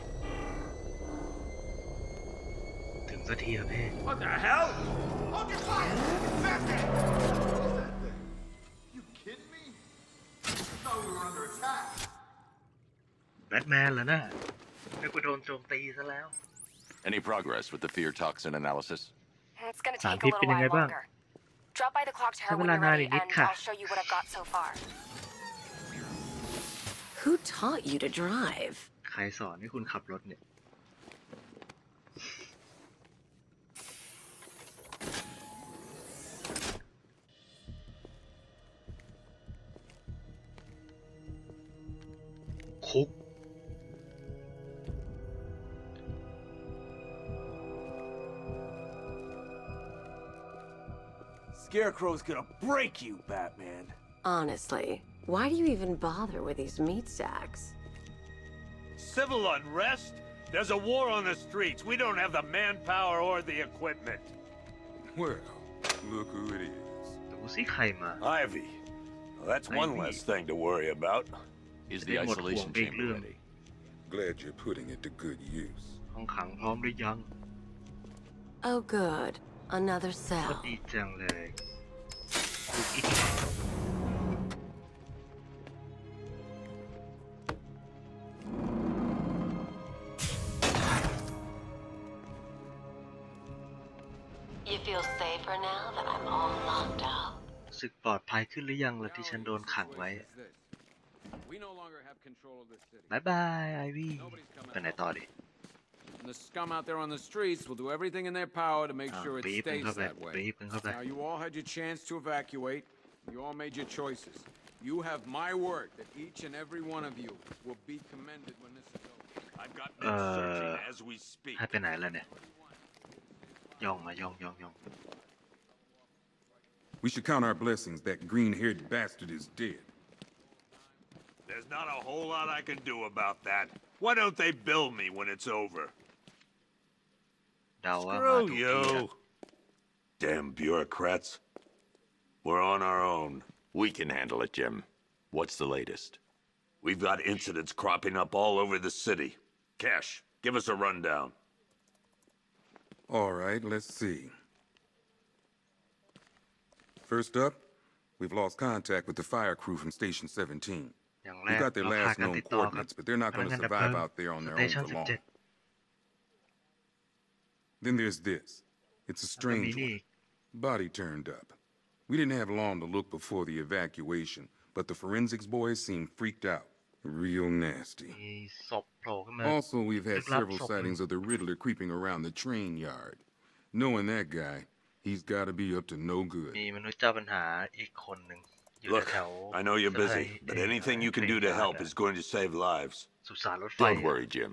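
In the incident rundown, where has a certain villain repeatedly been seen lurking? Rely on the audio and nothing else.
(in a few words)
The train yard.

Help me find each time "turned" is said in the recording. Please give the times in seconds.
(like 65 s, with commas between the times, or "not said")
170 s.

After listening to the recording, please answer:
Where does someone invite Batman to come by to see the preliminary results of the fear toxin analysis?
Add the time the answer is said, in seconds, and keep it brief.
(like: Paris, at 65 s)
Clock tower, at 22 s.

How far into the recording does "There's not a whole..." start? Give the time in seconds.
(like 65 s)
131 s.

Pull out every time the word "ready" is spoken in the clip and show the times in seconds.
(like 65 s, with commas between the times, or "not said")
22 s, 73 s.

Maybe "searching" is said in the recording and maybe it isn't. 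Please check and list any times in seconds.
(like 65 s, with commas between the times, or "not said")
120 s.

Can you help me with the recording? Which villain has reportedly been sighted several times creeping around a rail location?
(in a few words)
The Riddler.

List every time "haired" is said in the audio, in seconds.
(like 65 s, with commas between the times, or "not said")
128 s.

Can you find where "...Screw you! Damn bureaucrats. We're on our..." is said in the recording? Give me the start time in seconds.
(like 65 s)
138 s.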